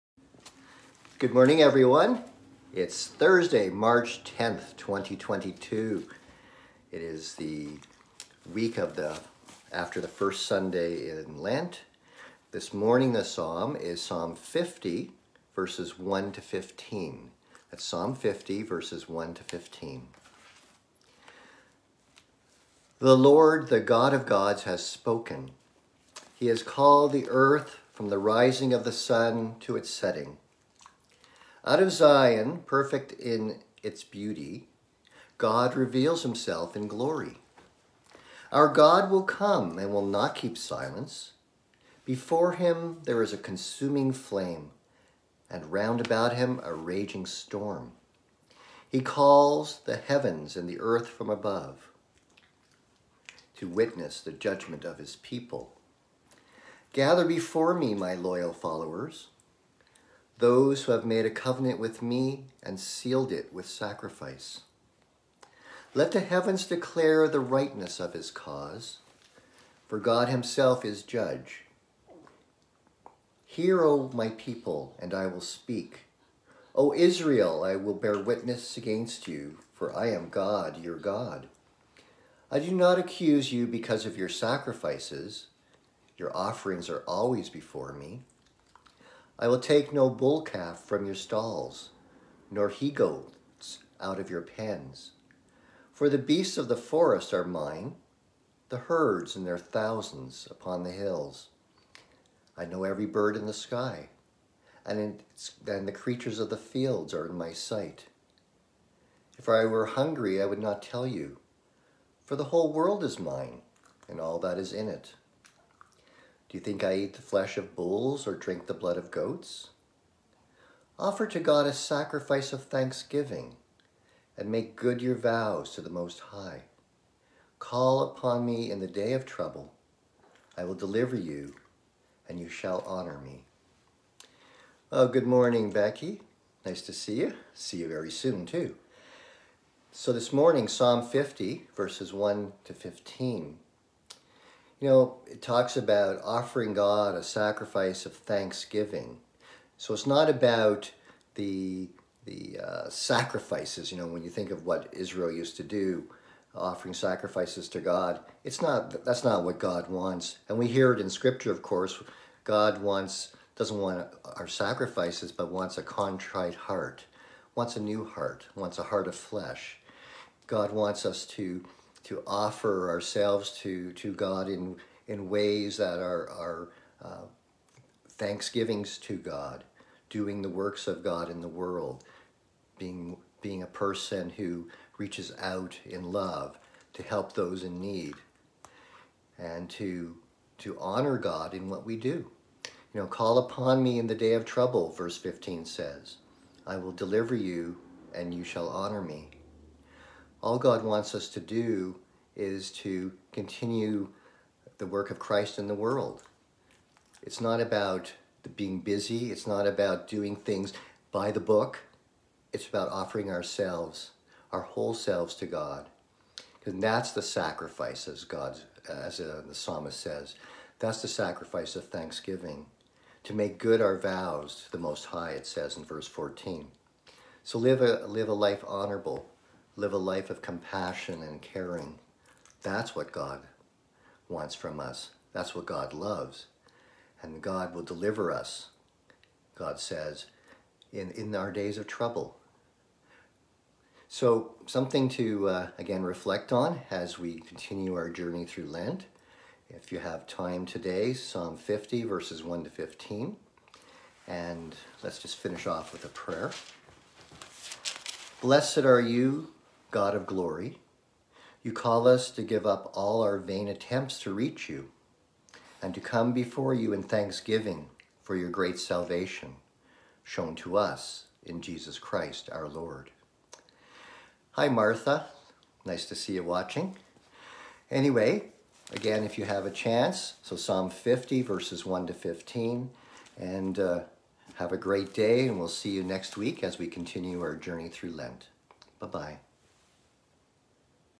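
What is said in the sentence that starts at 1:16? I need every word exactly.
O Israel, I will bear witness against you, for I am God, your God.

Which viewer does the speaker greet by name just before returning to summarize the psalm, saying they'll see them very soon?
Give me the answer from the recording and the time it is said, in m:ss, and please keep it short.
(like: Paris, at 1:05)
Becky, at 2:15.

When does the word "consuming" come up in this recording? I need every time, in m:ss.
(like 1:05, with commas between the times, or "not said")
0:43.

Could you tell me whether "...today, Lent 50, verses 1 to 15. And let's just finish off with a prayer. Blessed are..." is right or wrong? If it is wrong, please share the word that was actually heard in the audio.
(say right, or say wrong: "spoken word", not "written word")
wrong: "Psalm", not "Lent".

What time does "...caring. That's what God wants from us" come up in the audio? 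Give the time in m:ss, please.
3:51.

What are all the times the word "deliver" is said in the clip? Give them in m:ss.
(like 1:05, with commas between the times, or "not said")
2:10, 3:16, 3:57.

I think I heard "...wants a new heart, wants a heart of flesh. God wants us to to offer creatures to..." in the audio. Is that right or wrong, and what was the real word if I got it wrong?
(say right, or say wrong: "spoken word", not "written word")
wrong: "ourselves", not "creatures".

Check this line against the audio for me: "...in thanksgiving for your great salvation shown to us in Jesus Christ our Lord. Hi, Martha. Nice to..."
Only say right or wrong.
right.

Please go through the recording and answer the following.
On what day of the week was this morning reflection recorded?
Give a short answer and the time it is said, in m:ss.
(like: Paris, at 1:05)
Thursday, at 0:03.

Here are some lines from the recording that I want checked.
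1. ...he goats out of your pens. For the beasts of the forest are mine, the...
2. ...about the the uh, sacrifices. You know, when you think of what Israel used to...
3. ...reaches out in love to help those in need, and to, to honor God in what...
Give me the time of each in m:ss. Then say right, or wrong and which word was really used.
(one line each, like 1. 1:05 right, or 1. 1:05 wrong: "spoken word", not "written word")
1. 1:32 right
2. 2:30 right
3. 3:04 right.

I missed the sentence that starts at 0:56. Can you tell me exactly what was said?
Gather before me, my loyal followers, those who have made a covenant with me and sealed it with sacrifice.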